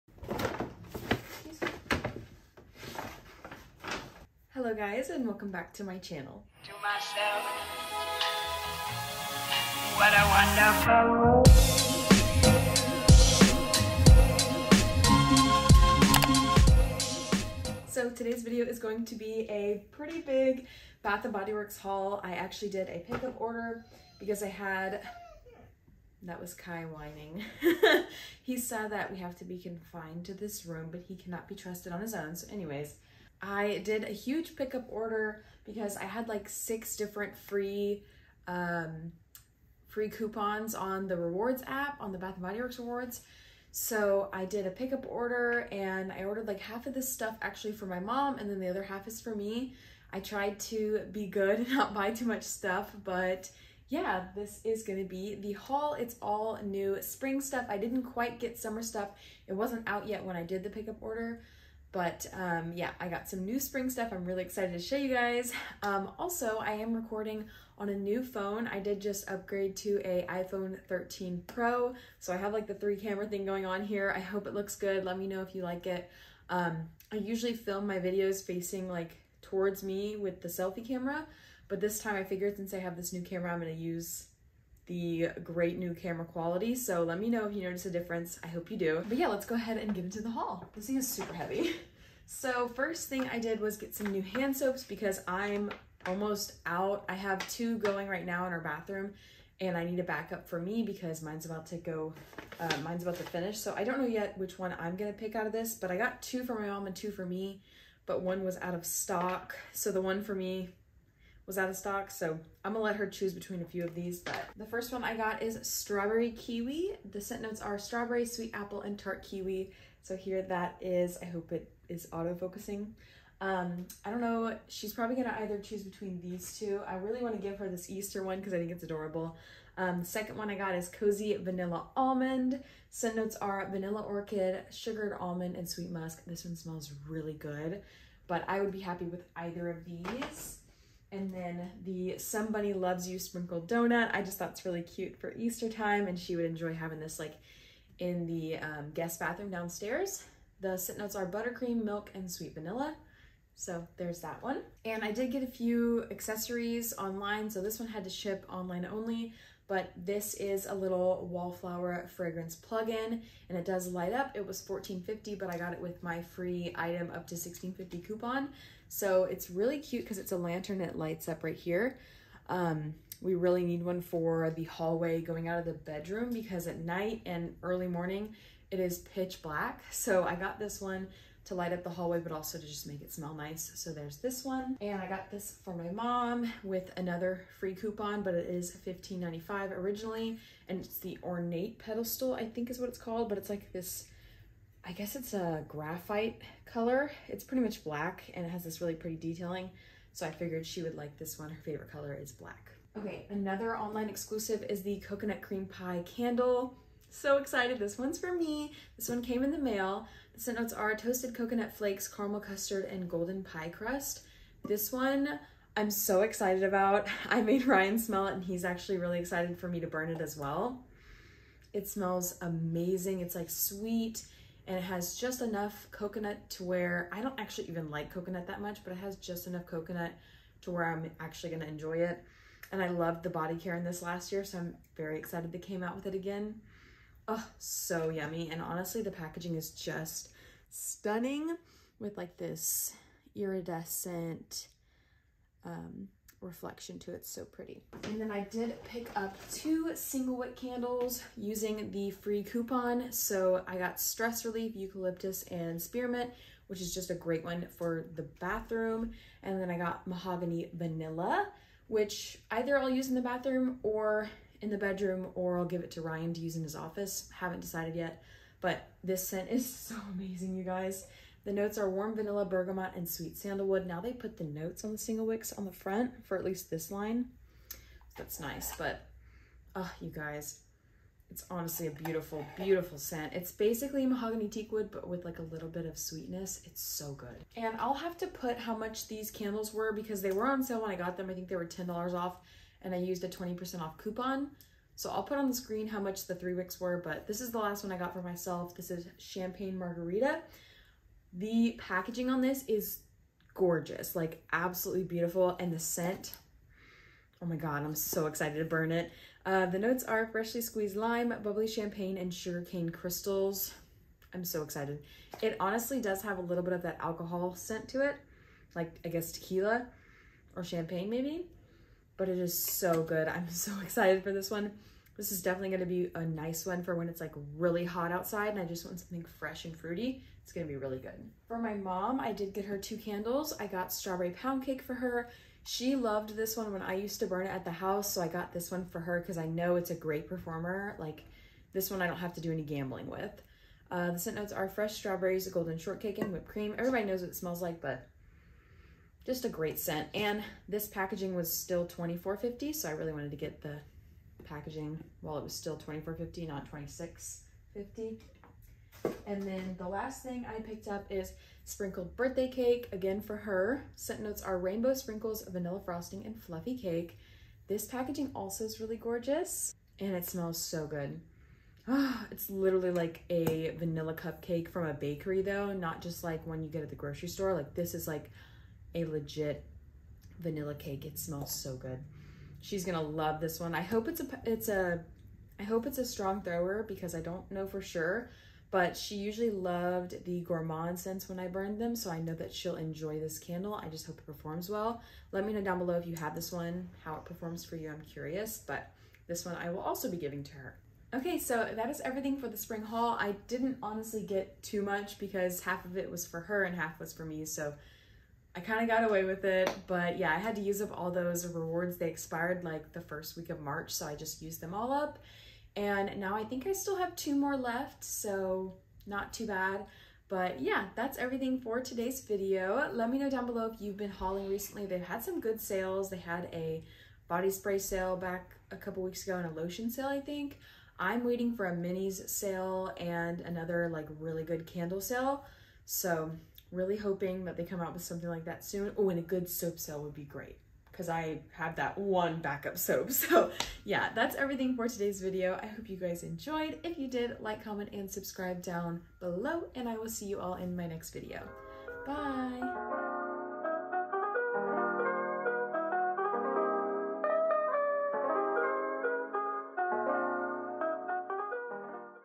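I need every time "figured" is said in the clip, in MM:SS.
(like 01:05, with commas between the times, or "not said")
01:22, 03:20.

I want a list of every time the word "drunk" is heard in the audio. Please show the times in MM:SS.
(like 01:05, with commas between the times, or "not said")
not said.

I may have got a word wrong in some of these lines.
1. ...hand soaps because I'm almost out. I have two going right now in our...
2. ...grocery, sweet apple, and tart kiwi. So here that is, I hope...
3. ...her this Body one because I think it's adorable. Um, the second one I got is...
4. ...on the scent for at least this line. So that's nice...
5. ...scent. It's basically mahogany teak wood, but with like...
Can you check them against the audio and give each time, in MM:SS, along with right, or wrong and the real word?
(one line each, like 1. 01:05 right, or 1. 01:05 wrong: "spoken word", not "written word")
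1. 01:34 right
2. 01:57 wrong: "strawberry", not "grocery"
3. 02:07 wrong: "Easter", not "Body"
4. 04:35 wrong: "front", not "scent"
5. 04:42 right.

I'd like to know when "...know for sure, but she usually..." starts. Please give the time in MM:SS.
06:27.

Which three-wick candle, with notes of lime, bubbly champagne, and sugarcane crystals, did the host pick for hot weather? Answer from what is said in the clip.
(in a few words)
Champagne Margarita.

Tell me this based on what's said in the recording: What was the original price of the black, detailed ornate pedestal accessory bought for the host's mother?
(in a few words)
$15.95.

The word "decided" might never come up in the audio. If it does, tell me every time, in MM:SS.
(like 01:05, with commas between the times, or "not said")
04:27.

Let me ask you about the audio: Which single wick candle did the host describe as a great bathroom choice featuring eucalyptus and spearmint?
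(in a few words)
Stress Relief.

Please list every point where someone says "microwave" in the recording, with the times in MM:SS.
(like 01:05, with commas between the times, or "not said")
not said.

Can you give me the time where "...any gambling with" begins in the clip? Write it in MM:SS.
05:42.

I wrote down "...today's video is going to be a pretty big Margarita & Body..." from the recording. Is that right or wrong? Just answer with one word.
wrong.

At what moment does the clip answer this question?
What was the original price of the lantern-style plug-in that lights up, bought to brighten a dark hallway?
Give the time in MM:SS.
02:44.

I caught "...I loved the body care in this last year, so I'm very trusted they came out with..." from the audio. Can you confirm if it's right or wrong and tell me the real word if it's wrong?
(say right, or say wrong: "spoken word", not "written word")
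wrong: "excited", not "trusted".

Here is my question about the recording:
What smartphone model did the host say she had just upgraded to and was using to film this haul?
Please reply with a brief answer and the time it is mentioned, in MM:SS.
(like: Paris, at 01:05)
iPhone 13 Pro, at 01:10.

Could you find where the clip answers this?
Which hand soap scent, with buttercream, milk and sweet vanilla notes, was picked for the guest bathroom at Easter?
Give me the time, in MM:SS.
02:22.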